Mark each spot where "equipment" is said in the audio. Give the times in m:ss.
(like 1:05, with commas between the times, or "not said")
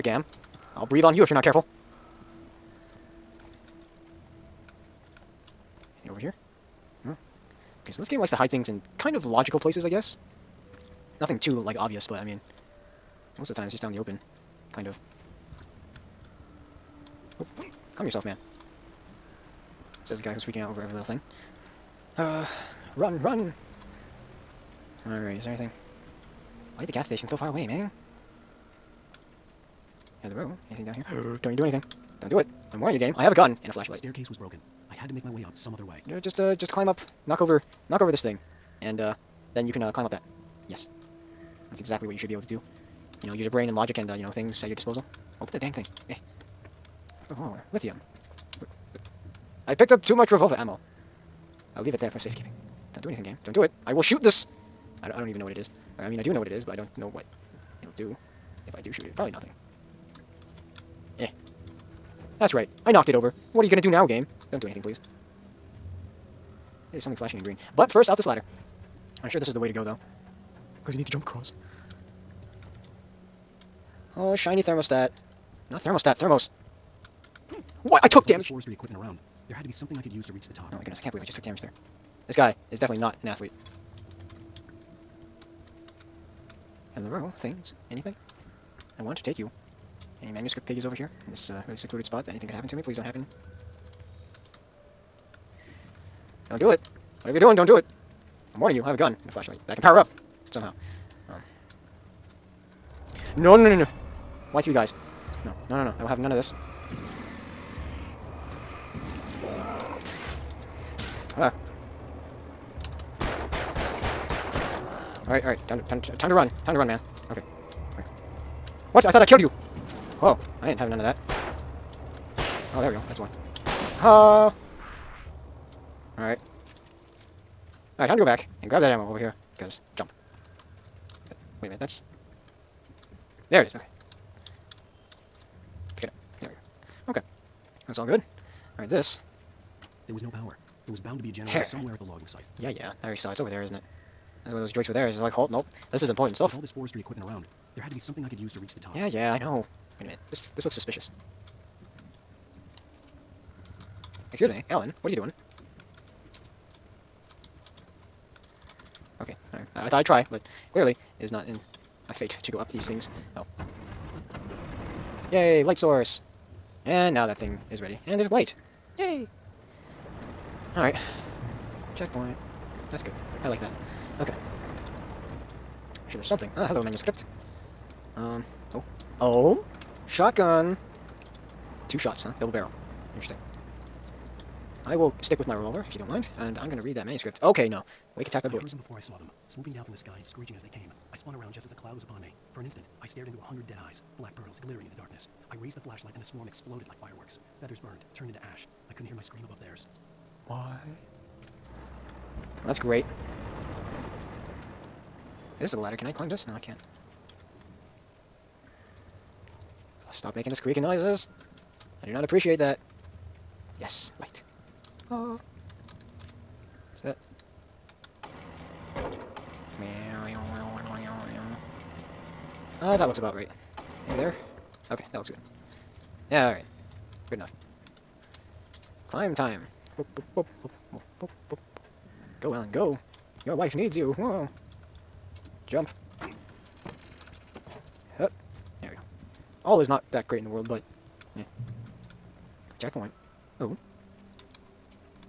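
1:18, 2:27.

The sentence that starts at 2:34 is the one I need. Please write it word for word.
Excuse me, Alan, what are you doing?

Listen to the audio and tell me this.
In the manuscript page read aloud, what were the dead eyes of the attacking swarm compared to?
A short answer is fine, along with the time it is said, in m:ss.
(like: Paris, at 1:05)
Black pearls, at 3:14.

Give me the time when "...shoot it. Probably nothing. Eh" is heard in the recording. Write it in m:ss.
0:58.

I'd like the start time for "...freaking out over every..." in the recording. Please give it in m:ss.
0:20.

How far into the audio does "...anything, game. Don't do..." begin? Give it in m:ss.
0:53.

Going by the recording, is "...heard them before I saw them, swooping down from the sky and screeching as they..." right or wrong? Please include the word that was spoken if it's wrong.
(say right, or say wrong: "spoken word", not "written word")
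right.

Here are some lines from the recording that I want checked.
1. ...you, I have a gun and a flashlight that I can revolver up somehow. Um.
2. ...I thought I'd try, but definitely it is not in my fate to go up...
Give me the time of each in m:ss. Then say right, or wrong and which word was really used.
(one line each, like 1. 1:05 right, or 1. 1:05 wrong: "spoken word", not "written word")
1. 1:38 wrong: "power", not "revolver"
2. 2:39 wrong: "clearly", not "definitely".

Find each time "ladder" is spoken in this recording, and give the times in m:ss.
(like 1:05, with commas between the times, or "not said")
1:08, 3:25.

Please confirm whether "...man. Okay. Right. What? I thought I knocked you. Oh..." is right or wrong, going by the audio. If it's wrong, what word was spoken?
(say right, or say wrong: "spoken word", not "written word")
wrong: "killed", not "knocked".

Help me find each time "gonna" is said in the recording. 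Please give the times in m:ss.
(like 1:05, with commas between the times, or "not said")
1:03, 3:06.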